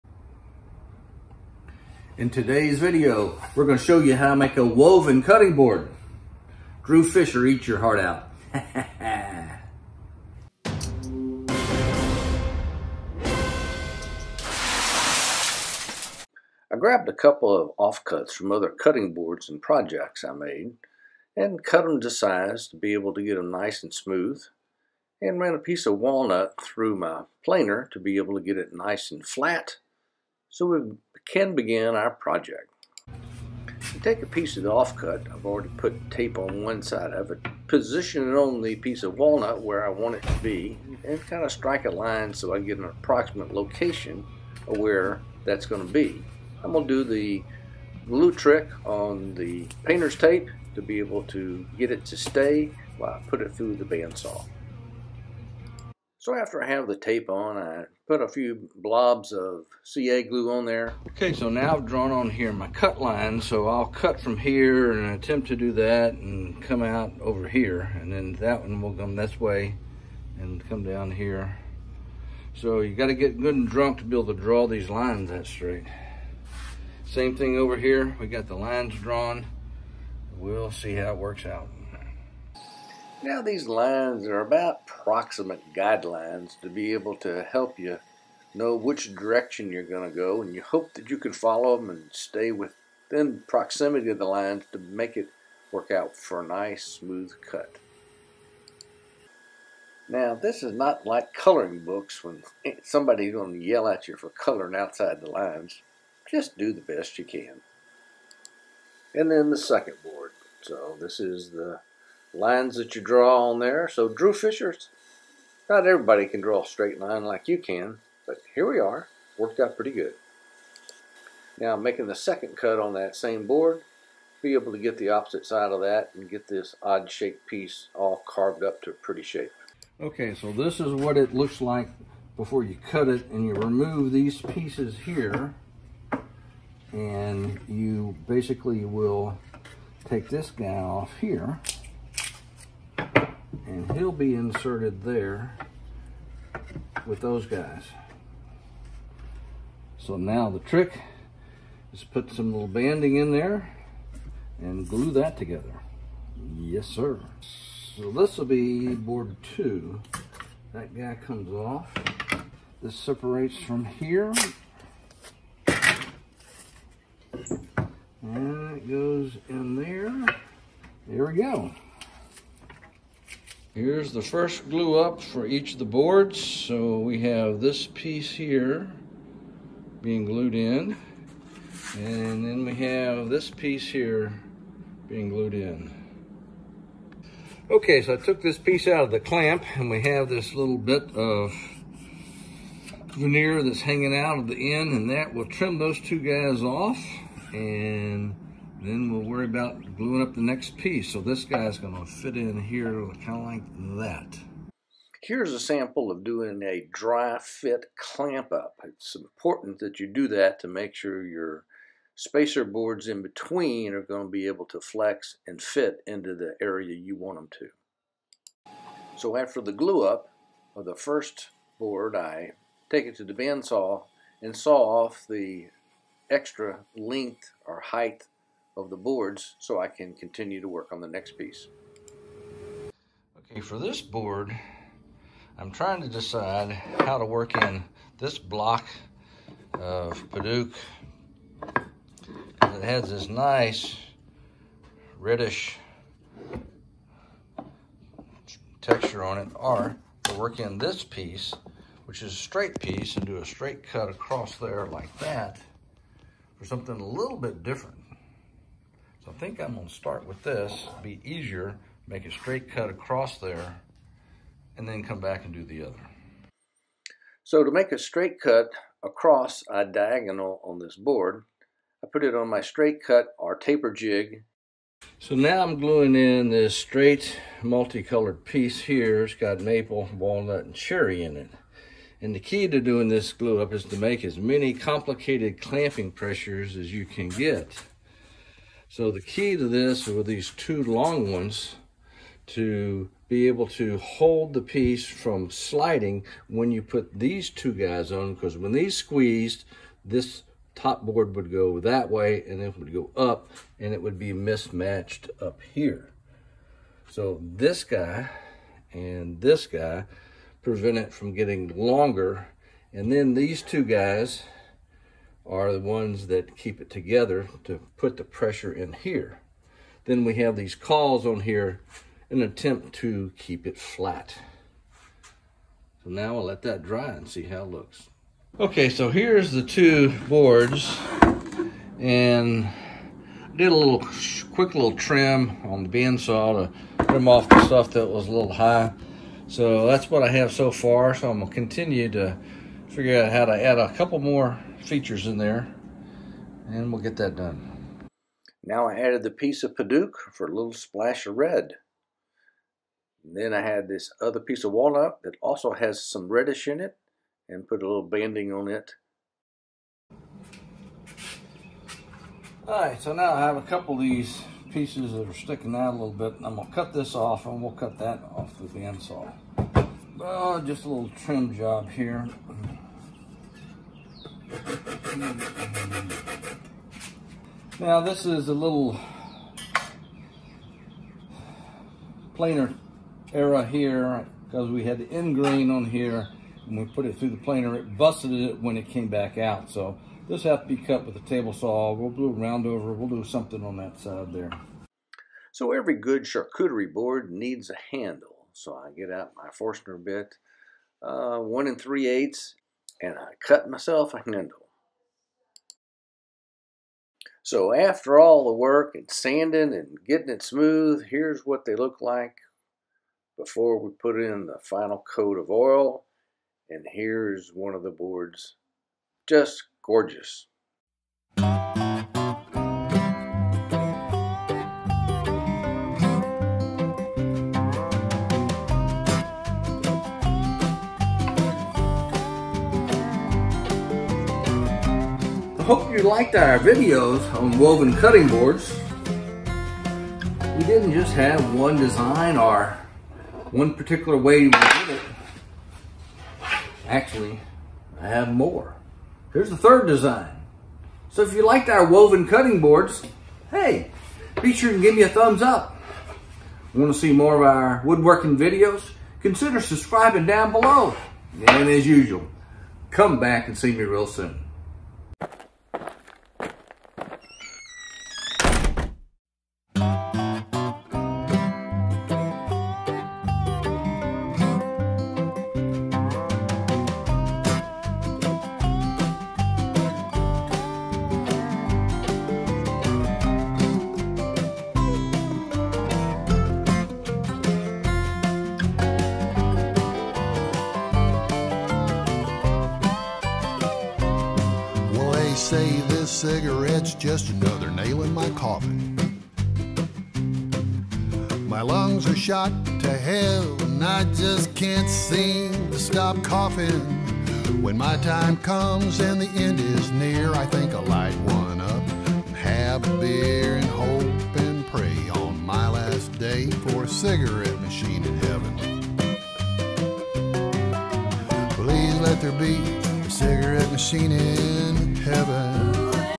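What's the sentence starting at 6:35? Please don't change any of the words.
So every good charcuterie board needs a handle.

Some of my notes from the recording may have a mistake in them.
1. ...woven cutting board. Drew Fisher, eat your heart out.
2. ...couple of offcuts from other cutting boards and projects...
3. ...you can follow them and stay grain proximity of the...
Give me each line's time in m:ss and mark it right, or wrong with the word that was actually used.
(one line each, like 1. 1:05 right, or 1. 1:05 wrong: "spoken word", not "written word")
1. 0:04 right
2. 0:17 right
3. 1:31 wrong: "within", not "grain".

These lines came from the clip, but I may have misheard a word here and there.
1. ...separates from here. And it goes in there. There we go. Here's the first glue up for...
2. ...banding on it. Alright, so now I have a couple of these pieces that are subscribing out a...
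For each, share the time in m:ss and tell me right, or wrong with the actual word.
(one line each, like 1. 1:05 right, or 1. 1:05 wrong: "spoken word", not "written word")
1. 2:42 right
2. 5:58 wrong: "sticking", not "subscribing".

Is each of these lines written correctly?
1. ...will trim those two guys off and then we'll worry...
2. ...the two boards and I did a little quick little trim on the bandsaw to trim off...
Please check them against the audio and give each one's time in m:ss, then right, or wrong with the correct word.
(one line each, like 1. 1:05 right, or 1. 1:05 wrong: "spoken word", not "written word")
1. 3:15 right
2. 5:29 right.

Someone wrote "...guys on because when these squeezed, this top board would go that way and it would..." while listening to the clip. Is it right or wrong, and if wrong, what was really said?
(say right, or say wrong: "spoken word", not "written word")
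right.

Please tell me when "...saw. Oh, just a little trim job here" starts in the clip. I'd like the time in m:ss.
6:09.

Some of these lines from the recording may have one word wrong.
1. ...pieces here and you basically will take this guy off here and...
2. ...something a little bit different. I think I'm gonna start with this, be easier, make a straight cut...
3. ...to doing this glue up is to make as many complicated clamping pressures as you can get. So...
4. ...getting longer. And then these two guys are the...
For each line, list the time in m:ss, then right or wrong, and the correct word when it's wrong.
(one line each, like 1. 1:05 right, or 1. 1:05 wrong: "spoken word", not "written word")
1. 2:14 right
2. 4:16 right
3. 4:42 right
4. 5:11 right.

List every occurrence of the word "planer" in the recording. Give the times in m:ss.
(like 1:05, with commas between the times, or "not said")
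0:27, 6:22, 6:27.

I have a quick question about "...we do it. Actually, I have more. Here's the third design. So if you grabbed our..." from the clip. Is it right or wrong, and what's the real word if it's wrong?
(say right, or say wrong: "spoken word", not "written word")
wrong: "liked", not "grabbed".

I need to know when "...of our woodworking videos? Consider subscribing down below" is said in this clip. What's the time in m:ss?
7:37.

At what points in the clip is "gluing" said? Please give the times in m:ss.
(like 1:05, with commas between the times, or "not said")
3:19, 4:35.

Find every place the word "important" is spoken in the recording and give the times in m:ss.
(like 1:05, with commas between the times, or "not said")
3:29.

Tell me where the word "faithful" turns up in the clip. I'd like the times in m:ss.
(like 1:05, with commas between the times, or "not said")
not said.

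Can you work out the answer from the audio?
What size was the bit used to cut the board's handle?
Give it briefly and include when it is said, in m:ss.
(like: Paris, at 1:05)
1 3/8, at 6:41.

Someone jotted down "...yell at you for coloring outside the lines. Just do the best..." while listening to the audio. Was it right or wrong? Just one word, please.
right.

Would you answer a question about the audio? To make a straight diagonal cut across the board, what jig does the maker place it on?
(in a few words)
taper jig.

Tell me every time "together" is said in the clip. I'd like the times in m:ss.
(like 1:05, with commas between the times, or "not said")
2:35, 5:16.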